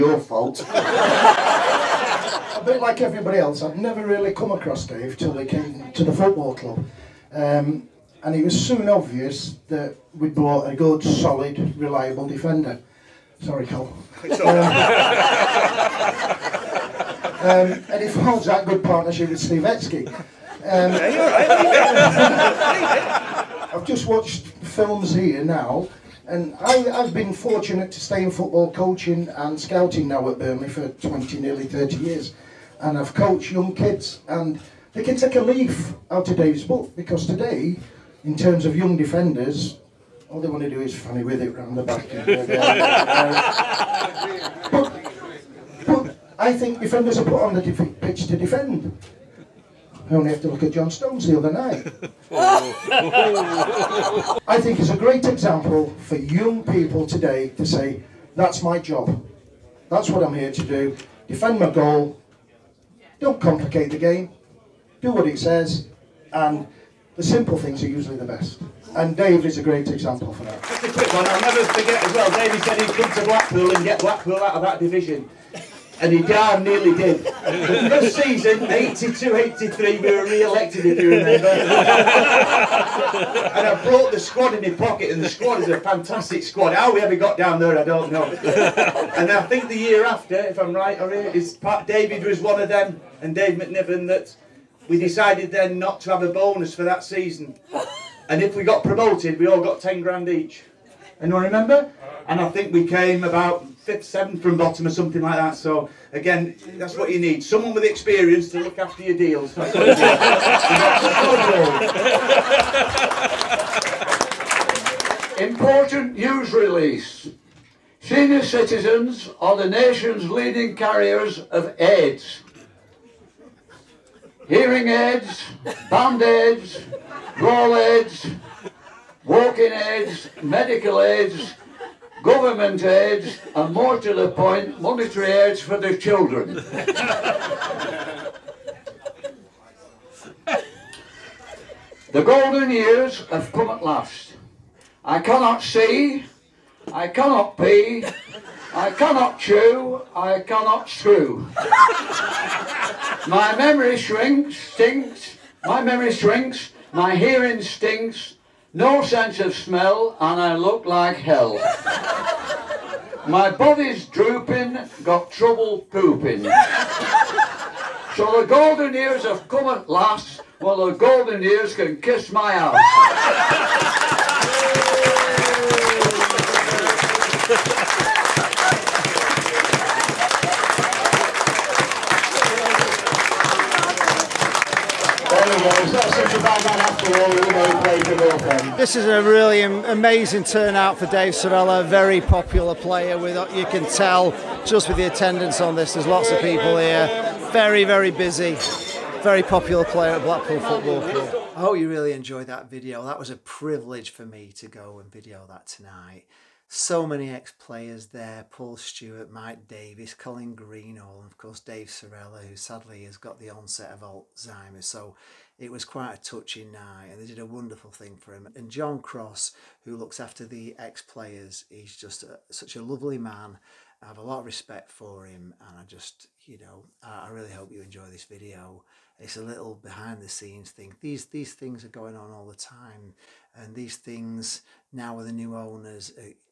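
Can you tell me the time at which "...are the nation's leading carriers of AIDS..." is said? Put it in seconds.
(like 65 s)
119 s.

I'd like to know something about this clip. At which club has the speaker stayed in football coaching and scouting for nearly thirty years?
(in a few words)
Burnley.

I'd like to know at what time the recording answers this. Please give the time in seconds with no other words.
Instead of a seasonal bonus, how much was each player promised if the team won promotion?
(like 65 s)
99 s.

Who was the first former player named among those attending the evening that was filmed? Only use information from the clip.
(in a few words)
Paul Stewart.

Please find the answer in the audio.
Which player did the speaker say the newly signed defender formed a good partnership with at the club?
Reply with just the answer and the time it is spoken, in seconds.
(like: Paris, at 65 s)
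Steve Etsky, at 19 s.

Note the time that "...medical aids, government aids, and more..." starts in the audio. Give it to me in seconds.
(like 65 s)
130 s.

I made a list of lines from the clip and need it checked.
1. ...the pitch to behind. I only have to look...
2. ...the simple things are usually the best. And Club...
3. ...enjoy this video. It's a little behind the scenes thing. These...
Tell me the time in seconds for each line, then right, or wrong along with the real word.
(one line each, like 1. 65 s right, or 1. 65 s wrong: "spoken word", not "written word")
1. 47 s wrong: "defend", not "behind"
2. 67 s wrong: "Dave", not "Club"
3. 227 s right.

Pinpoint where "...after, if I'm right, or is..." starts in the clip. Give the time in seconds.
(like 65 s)
90 s.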